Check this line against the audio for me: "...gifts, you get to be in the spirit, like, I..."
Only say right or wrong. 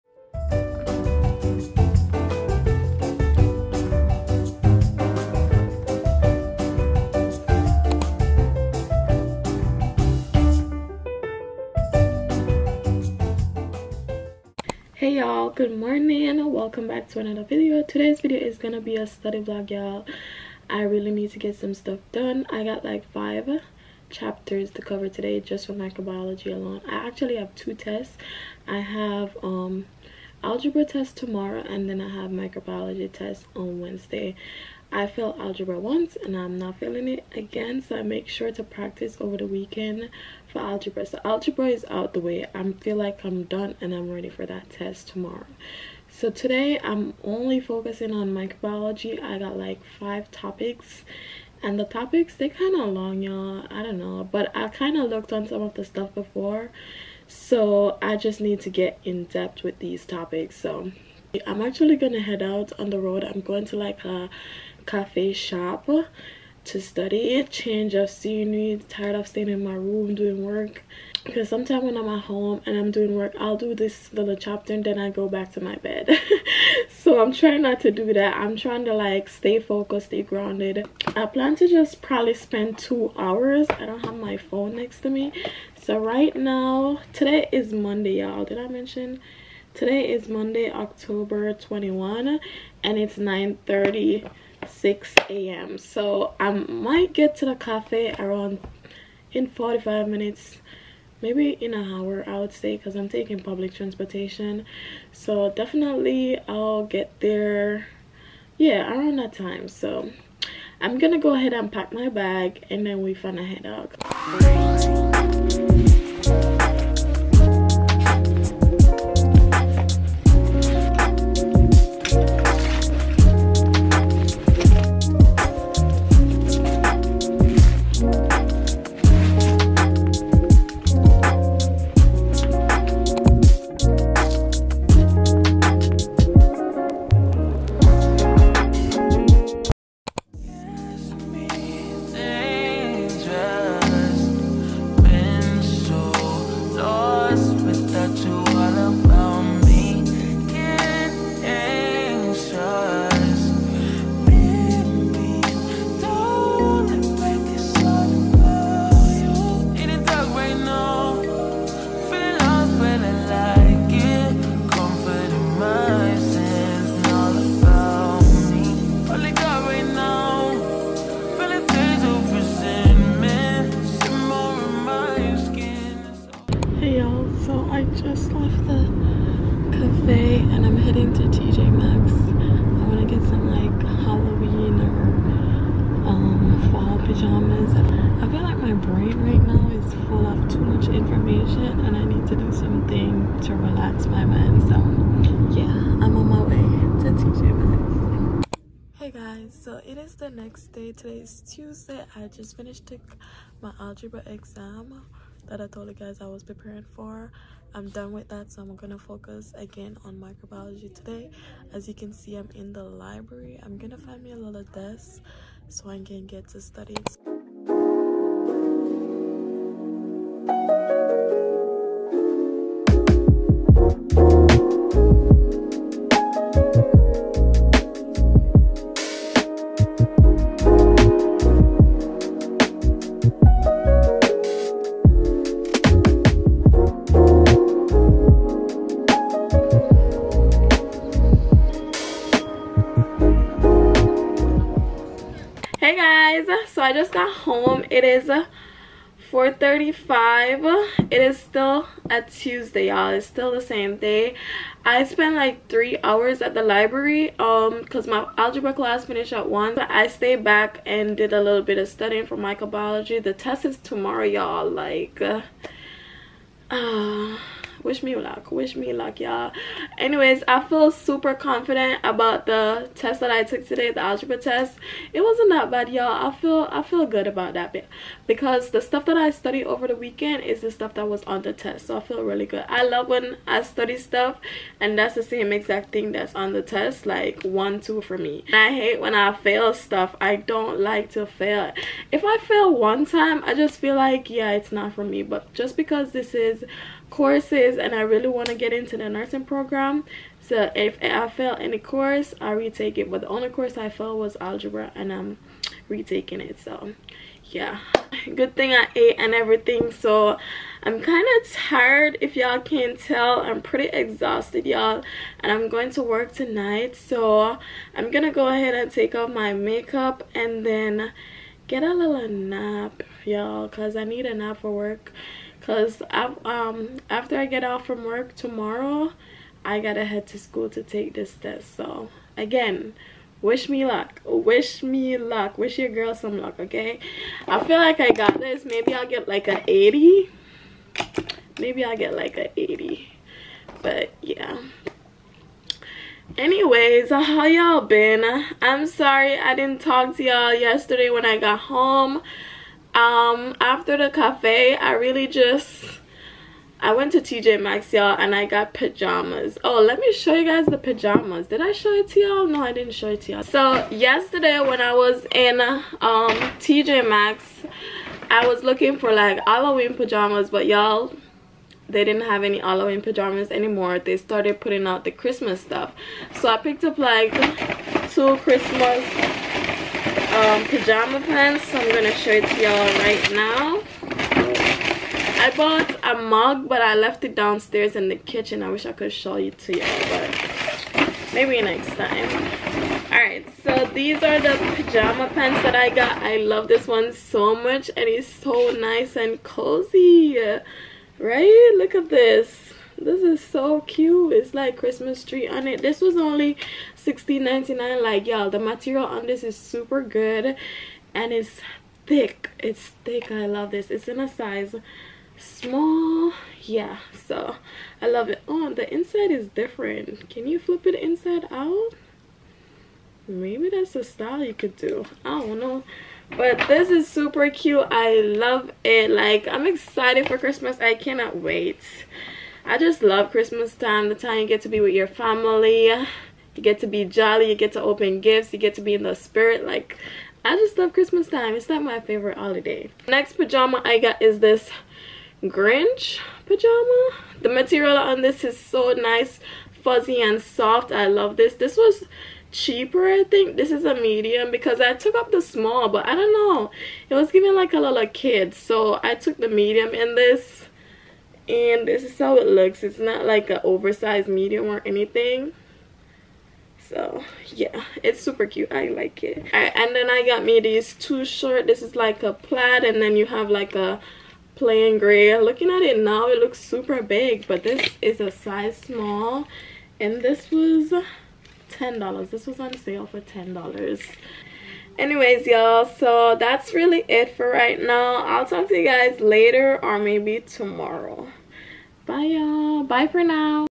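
right.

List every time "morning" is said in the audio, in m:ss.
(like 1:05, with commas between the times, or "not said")
0:15.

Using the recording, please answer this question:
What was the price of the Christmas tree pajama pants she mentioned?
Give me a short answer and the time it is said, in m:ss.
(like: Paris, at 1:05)
$16.99, at 6:47.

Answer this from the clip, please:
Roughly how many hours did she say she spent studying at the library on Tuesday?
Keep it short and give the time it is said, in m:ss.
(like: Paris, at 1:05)
3, at 4:15.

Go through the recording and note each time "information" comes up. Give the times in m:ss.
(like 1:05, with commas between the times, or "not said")
3:10.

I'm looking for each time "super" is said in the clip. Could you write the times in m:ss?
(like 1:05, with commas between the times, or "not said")
4:30, 6:49, 7:07, 7:48, 7:56.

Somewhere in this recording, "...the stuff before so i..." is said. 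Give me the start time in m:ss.
0:55.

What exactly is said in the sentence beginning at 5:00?
So if I fail any course, I retake it.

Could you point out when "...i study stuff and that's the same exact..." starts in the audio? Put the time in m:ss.
4:43.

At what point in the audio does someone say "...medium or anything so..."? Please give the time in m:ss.
7:44.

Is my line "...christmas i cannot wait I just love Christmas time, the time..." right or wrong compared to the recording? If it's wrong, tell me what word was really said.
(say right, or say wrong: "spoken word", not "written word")
right.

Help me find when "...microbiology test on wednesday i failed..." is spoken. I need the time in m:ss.
0:32.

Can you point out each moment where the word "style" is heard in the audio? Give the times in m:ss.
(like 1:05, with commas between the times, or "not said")
7:04.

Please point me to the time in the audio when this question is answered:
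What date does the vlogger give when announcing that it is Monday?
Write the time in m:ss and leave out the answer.
1:30.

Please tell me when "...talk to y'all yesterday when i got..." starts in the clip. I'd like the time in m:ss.
5:49.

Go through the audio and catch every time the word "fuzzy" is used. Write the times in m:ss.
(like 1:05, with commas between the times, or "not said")
7:29.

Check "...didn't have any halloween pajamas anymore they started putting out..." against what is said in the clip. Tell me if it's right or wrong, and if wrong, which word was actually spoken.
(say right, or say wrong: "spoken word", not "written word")
right.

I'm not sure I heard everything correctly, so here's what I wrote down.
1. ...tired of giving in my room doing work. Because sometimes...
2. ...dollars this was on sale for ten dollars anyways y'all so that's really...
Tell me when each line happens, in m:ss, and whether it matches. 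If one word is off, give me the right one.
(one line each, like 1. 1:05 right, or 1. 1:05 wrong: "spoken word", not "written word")
1. 1:08 wrong: "staying", not "giving"
2. 8:01 right.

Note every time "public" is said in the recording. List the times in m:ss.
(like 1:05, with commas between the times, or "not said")
1:43.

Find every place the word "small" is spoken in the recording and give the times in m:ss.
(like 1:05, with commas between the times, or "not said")
6:55, 7:35, 7:58.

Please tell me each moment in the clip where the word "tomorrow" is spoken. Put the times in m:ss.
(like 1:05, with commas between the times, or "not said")
0:31, 0:45, 4:23, 5:28, 8:10.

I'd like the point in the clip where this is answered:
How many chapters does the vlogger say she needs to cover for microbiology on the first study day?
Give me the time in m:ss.
0:23.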